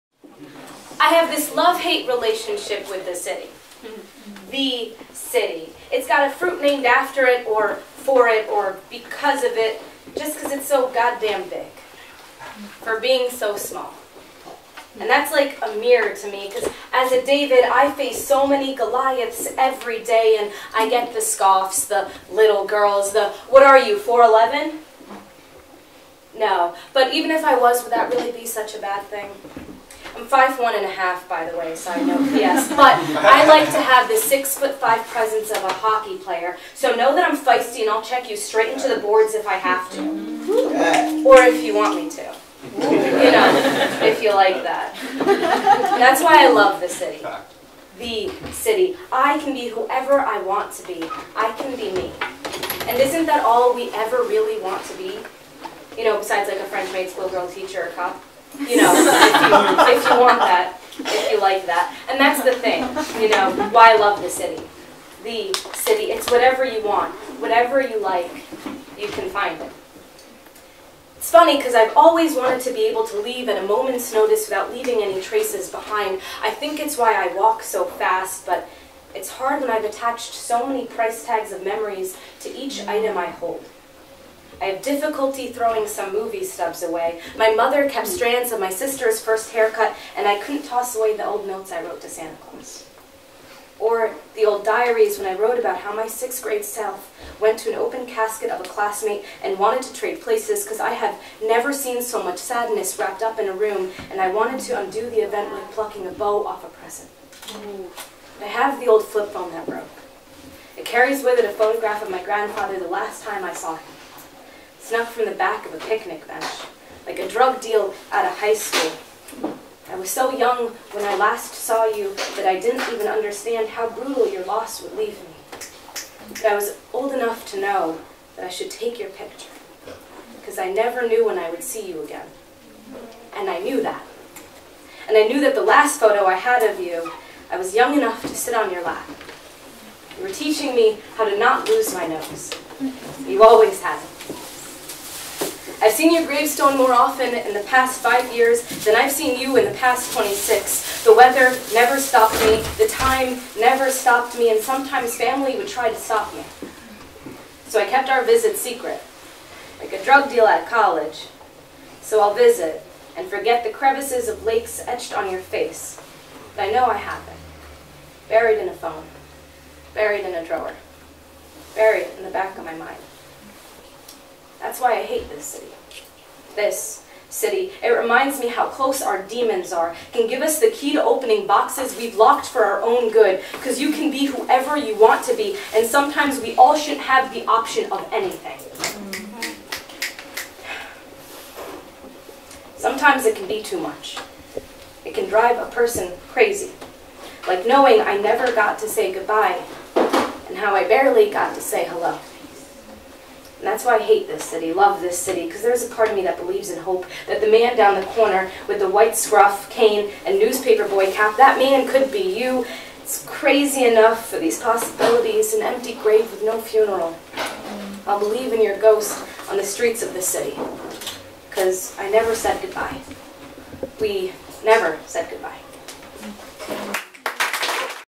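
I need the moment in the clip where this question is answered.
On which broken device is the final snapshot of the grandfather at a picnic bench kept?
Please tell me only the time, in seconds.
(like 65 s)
109 s.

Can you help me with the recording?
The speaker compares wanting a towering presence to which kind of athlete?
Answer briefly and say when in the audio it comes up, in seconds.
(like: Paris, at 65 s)
Hockey player, at 35 s.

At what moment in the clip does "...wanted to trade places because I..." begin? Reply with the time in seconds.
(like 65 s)
99 s.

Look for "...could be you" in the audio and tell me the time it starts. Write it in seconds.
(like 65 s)
211 s.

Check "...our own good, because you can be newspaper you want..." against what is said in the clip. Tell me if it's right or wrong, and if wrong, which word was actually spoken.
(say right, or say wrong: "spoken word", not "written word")
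wrong: "whoever", not "newspaper".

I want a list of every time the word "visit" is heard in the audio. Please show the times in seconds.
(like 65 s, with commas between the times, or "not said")
158 s, 162 s.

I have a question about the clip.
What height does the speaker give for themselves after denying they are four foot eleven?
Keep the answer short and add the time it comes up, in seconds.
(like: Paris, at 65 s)
5'1.5", at 30 s.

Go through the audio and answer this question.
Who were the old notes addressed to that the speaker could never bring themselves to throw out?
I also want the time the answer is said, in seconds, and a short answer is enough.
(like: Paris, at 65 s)
Santa Claus, at 92 s.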